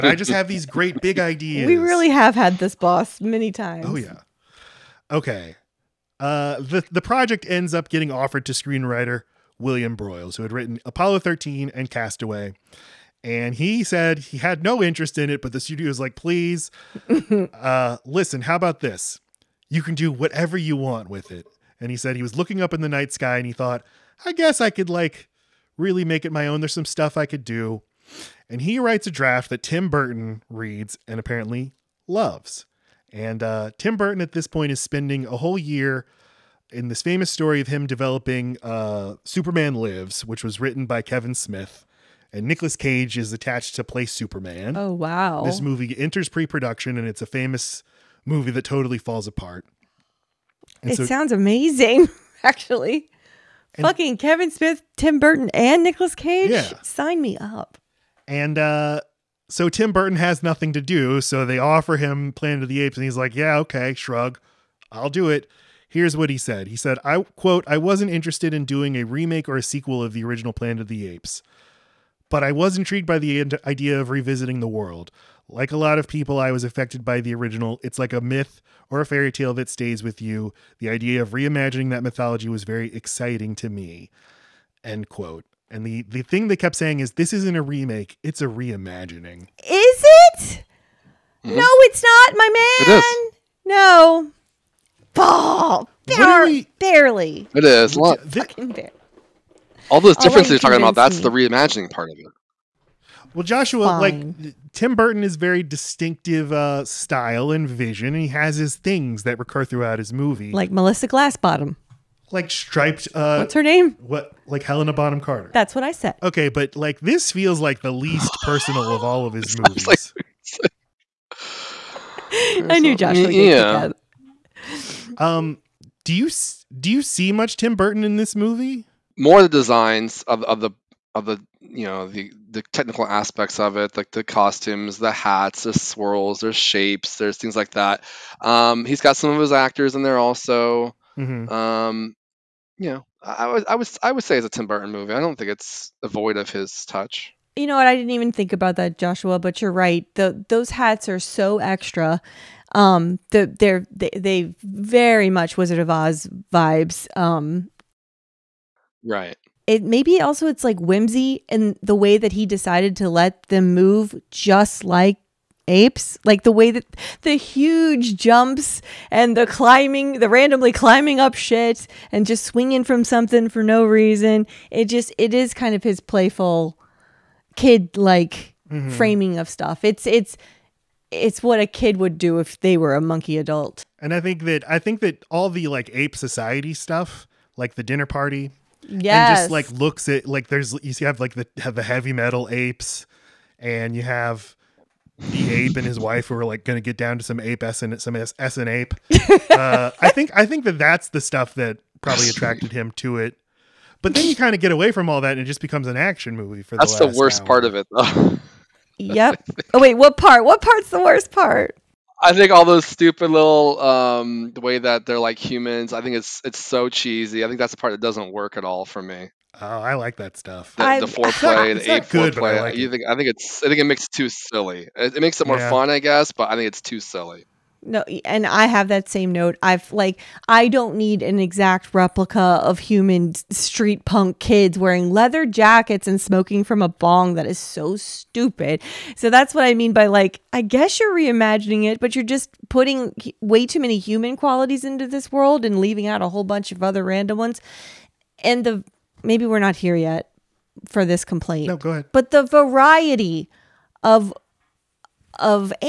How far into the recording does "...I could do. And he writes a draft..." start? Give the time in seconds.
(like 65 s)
27 s.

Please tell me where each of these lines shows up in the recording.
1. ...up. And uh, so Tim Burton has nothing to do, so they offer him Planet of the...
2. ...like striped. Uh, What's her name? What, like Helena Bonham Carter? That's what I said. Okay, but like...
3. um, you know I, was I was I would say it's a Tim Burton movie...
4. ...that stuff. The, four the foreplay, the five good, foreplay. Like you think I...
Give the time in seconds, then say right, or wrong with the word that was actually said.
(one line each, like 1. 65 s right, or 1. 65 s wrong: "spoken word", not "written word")
1. 57 s right
2. 112 s right
3. 141 s right
4. 220 s wrong: "eight", not "five".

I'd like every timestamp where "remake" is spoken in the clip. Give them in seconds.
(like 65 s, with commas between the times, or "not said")
69 s, 87 s.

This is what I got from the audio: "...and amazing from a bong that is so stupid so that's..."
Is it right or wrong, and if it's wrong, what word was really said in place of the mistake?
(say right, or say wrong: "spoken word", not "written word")
wrong: "smoking", not "amazing".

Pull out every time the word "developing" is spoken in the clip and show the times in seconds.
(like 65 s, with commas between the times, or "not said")
37 s.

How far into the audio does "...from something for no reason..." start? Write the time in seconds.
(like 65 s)
172 s.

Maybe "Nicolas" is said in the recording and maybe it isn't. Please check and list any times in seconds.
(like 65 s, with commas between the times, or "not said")
42 s, 55 s.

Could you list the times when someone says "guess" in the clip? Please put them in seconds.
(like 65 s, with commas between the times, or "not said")
24 s, 226 s, 240 s.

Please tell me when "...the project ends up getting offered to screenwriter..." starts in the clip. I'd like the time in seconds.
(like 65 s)
6 s.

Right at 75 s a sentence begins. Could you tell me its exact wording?
Like a lot of people, I was affected by the original.